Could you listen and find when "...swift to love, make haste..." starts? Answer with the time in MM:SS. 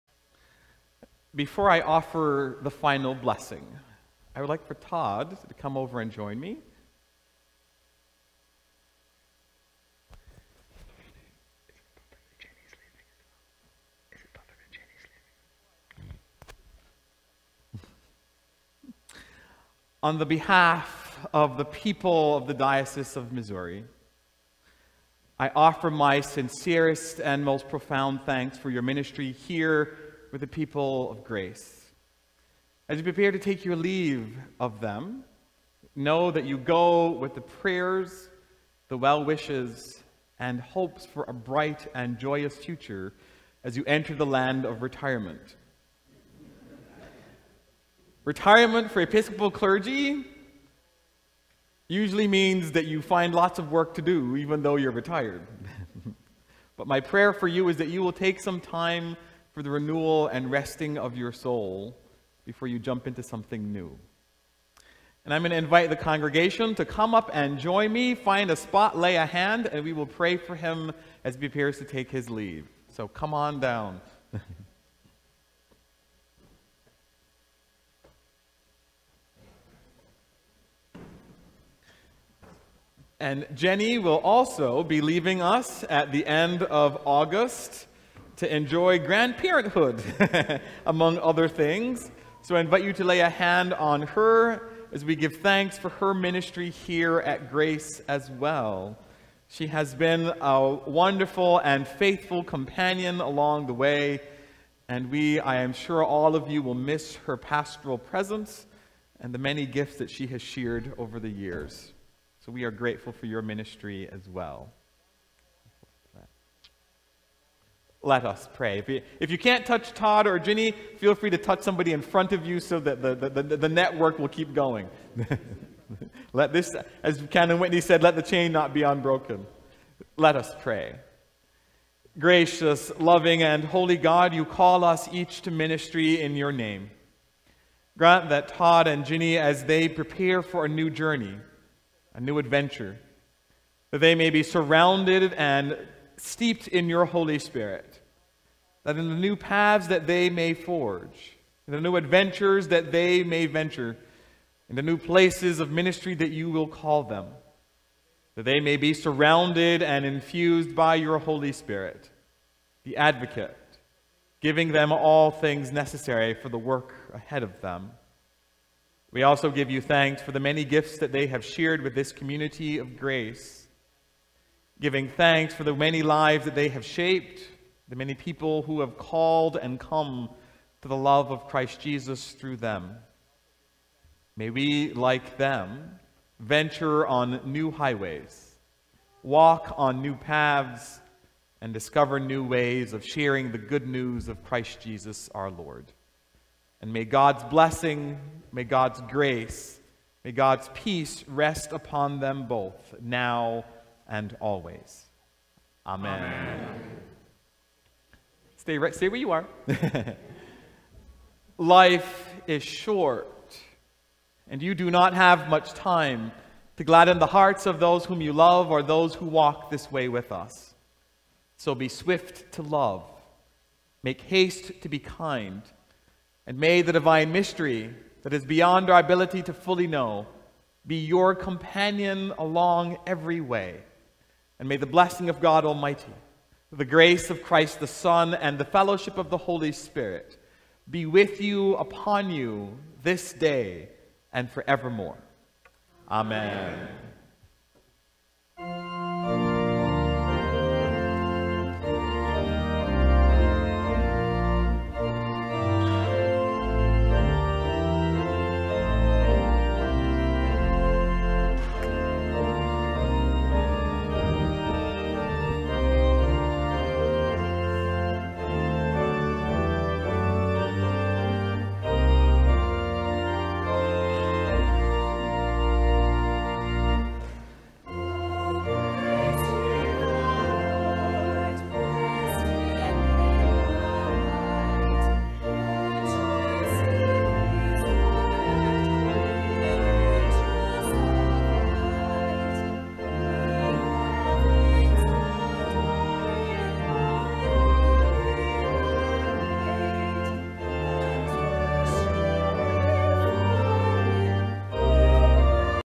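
03:41.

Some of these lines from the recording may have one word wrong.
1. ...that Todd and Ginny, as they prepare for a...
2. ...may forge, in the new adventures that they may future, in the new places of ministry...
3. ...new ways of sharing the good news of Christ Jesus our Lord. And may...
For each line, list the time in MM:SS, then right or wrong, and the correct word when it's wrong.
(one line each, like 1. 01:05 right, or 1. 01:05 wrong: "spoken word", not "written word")
1. 02:18 right
2. 02:30 wrong: "venture", not "future"
3. 03:12 right.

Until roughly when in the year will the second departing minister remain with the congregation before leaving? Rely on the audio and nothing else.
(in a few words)
End of August.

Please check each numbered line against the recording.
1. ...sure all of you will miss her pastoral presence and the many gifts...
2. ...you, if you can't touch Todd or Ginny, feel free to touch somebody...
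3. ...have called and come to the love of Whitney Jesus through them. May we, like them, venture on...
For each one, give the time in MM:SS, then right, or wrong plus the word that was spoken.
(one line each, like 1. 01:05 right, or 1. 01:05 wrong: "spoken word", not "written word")
1. 01:45 right
2. 01:58 right
3. 02:58 wrong: "Christ", not "Whitney".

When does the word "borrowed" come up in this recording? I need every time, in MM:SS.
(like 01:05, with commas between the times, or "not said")
not said.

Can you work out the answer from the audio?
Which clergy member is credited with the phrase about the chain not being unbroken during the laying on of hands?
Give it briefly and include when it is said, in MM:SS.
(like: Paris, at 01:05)
Canon Whitney, at 02:07.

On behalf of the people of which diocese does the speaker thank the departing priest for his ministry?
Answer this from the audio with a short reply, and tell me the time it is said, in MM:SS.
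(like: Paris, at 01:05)
Diocese of Missouri, at 00:22.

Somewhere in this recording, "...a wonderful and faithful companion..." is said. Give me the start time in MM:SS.
01:40.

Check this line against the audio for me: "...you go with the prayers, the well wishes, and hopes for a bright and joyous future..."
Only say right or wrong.
right.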